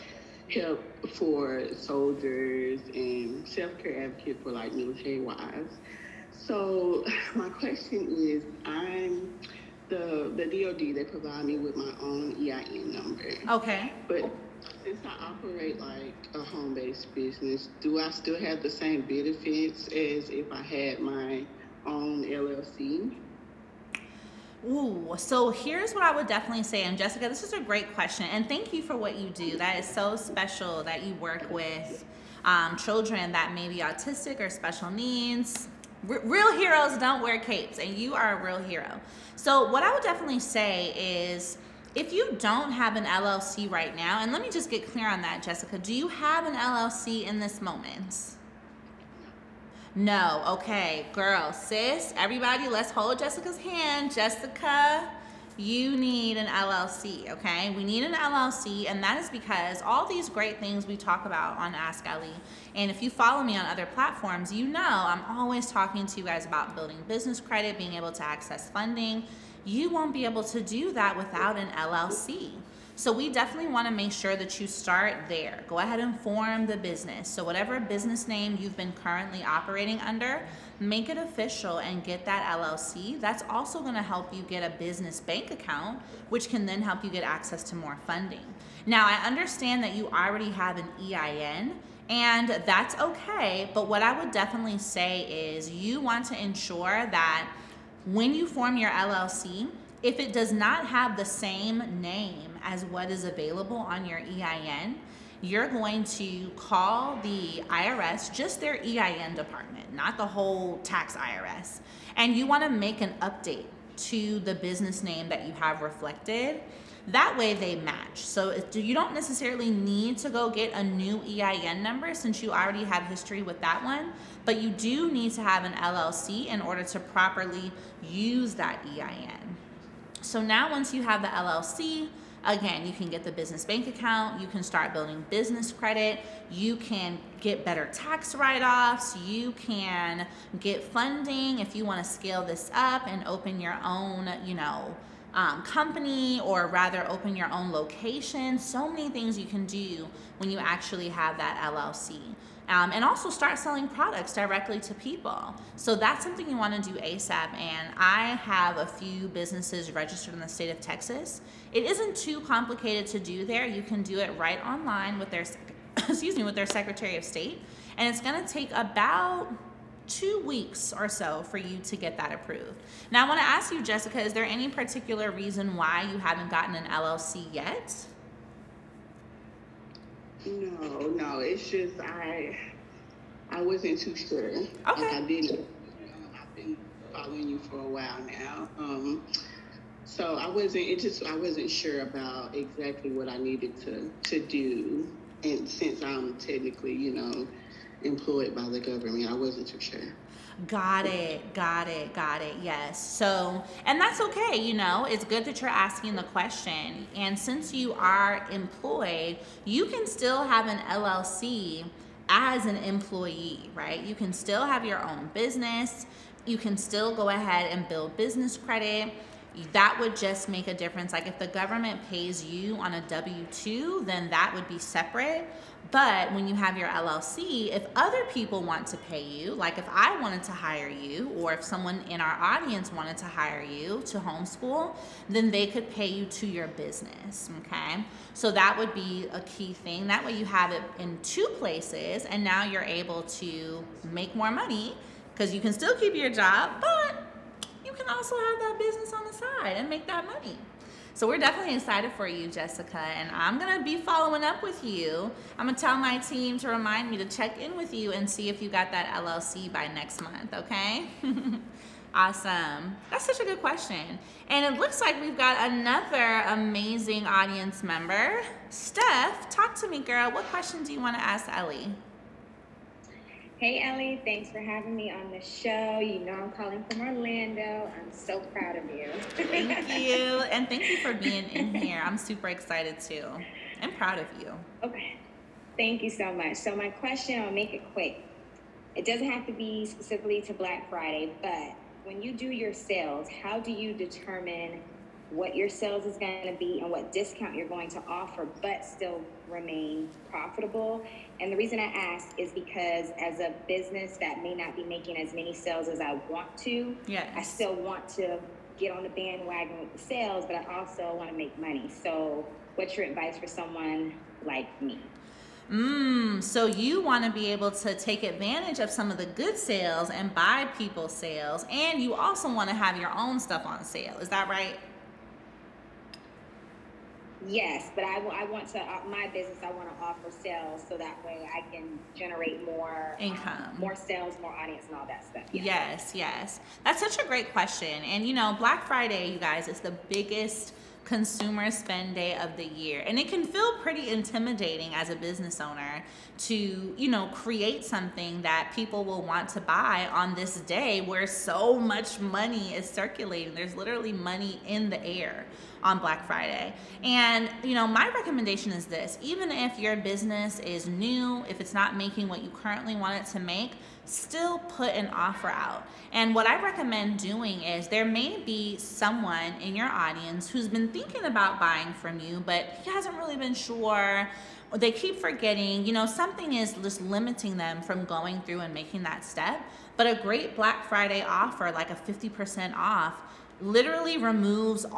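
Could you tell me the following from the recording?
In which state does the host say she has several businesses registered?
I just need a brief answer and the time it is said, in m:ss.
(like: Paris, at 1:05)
Texas, at 2:40.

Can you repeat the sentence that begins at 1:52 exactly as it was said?
And you want to make an update to the business name that you have reflected.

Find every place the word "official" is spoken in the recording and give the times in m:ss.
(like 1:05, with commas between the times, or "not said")
1:21.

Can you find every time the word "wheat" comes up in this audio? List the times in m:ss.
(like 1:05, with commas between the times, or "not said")
not said.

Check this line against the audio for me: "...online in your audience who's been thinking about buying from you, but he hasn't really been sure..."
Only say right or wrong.
wrong.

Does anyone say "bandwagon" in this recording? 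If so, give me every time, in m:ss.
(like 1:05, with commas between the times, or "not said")
5:09.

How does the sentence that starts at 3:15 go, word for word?
And since I'm technically, you know, employed by the government.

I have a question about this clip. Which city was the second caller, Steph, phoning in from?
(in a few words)
Orlando.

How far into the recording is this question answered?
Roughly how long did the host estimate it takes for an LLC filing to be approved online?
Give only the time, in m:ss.
2:48.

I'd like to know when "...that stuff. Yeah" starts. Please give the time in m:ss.
5:35.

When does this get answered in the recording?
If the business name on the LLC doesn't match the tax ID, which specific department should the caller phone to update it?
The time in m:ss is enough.
1:48.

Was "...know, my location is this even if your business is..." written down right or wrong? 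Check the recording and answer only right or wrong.
wrong.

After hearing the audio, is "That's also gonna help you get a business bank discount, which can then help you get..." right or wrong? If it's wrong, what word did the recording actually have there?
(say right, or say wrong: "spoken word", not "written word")
wrong: "account", not "discount".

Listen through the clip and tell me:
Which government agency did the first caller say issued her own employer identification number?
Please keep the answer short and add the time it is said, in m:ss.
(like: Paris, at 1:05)
DoD, at 0:10.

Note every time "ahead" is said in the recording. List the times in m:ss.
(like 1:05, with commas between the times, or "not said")
1:15, 3:37.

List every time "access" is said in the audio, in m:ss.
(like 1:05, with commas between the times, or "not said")
1:08, 1:27.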